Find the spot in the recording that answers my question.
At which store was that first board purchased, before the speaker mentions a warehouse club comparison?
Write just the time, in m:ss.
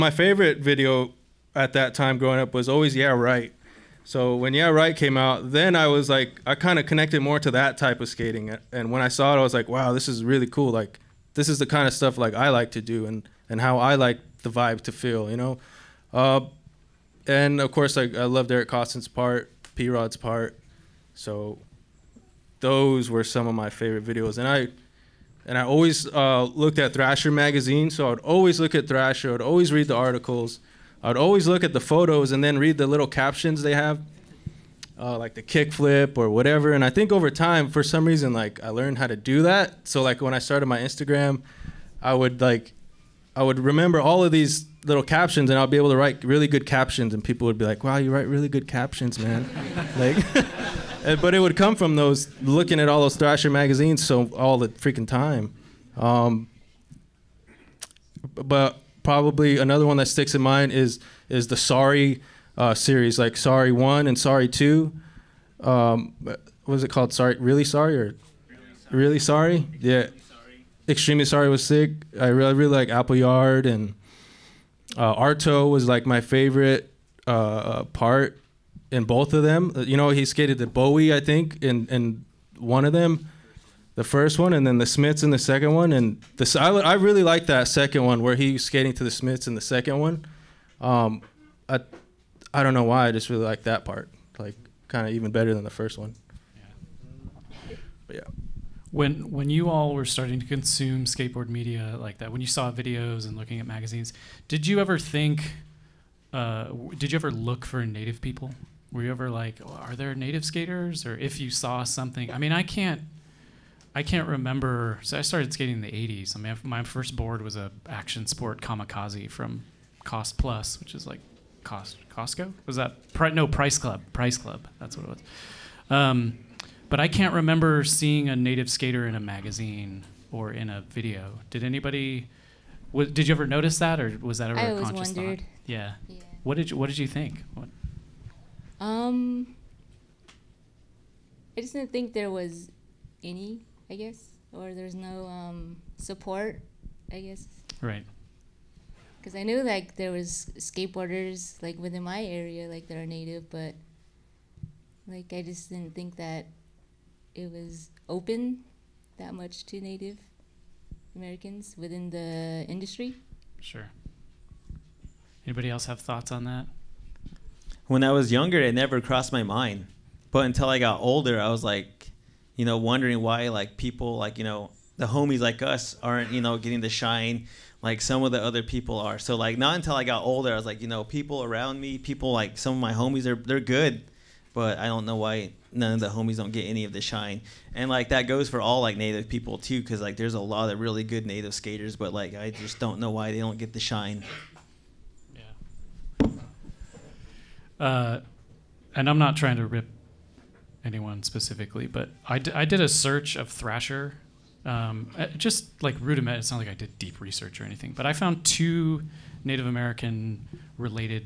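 2:00.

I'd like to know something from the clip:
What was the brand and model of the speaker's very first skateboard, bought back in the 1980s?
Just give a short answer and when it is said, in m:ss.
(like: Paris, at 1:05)
Action Sport Kamikaze, at 1:57.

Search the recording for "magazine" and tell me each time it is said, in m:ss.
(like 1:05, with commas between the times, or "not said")
0:27, 0:53, 1:43, 2:09.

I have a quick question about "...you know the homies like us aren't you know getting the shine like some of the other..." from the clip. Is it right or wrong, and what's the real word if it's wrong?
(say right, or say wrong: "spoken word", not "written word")
right.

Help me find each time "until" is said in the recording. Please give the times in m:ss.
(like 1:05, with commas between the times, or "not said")
2:50, 2:59.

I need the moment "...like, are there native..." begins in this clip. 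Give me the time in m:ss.
1:49.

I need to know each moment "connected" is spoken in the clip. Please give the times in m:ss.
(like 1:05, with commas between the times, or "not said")
0:06.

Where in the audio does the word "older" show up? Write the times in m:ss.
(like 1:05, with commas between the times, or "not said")
2:51, 3:00.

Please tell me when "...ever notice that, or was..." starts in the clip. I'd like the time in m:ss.
2:13.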